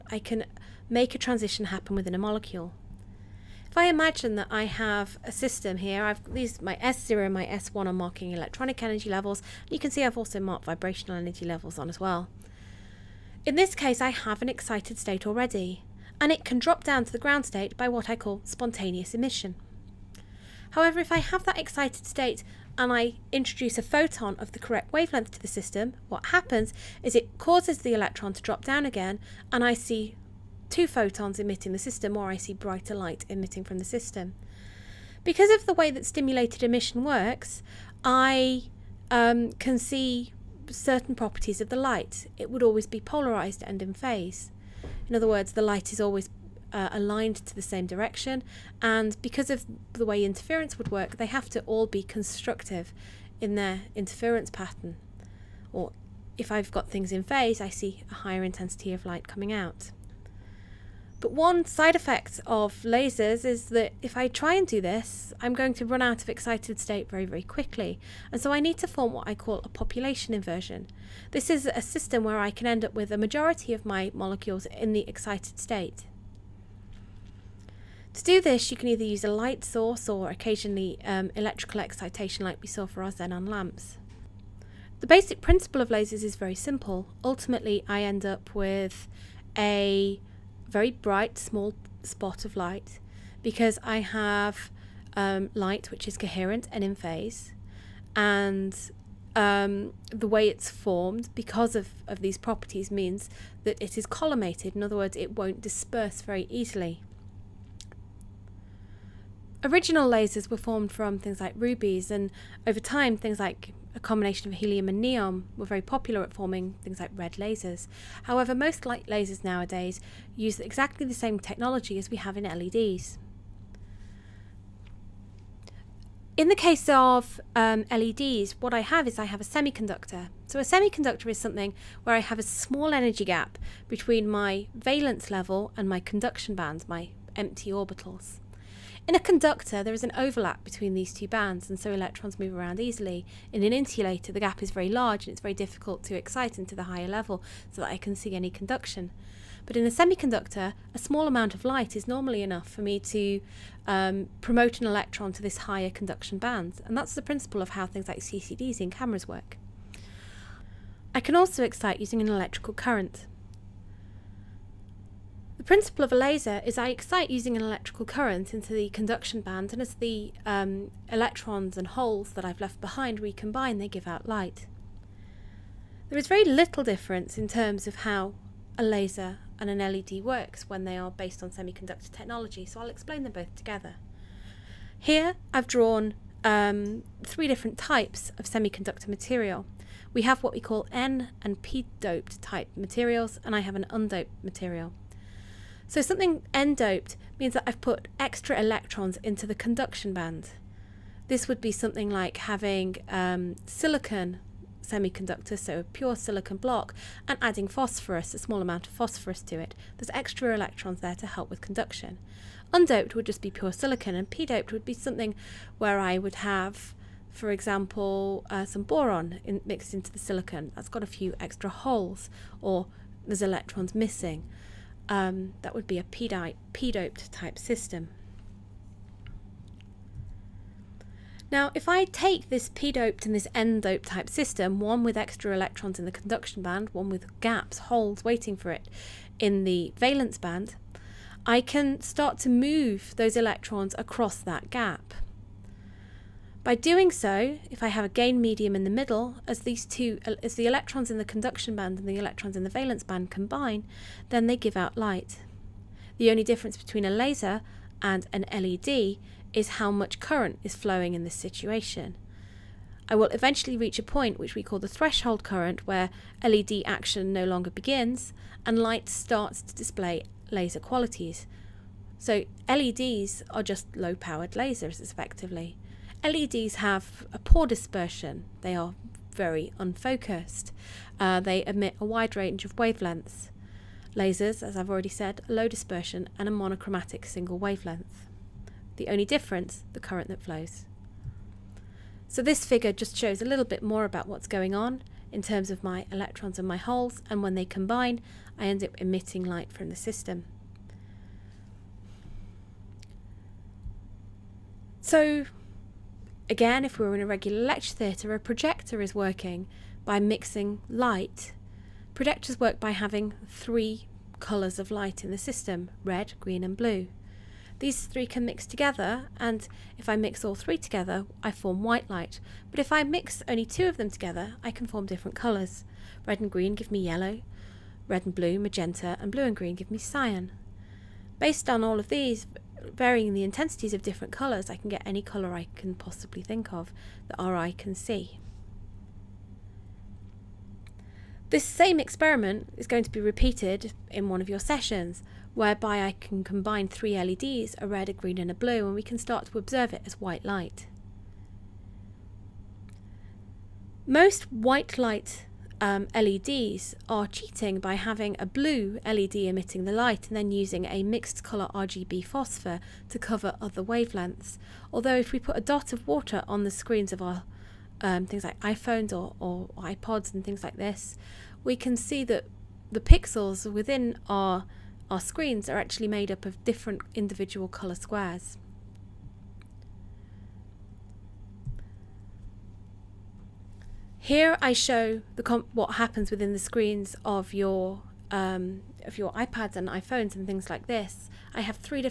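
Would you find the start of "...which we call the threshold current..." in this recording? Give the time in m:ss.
4:24.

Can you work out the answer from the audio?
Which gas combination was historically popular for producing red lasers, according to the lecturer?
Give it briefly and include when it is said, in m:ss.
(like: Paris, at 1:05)
helium and neon, at 1:54.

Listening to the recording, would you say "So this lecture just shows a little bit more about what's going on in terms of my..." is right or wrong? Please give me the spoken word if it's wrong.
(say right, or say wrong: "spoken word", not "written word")
wrong: "figure", not "lecture".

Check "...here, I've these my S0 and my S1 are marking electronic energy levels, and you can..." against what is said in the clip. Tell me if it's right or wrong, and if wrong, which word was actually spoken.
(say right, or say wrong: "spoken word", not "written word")
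right.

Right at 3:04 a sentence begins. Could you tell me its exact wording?
Here I've drawn um, three different types of semiconductor material.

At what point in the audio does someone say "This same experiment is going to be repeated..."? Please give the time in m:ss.
5:41.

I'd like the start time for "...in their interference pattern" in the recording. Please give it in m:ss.
0:53.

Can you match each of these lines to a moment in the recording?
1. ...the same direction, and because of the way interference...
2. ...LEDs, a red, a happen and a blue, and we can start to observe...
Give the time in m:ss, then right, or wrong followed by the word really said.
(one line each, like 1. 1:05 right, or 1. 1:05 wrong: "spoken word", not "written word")
1. 0:47 right
2. 5:47 wrong: "green", not "happen".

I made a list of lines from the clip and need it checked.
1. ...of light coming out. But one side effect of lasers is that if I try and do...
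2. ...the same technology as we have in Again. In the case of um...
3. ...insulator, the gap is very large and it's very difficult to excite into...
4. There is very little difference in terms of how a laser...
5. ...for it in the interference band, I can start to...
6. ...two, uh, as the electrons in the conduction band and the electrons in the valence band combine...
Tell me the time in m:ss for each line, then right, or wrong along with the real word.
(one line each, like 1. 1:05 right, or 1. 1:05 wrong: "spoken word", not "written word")
1. 0:58 right
2. 2:01 wrong: "LEDs", not "Again"
3. 2:23 right
4. 2:56 right
5. 3:58 wrong: "valence", not "interference"
6. 4:09 right.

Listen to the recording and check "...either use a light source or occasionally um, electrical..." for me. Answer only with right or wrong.
right.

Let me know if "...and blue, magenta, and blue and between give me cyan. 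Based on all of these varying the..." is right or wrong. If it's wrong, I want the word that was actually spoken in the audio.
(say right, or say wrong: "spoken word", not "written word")
wrong: "green", not "between".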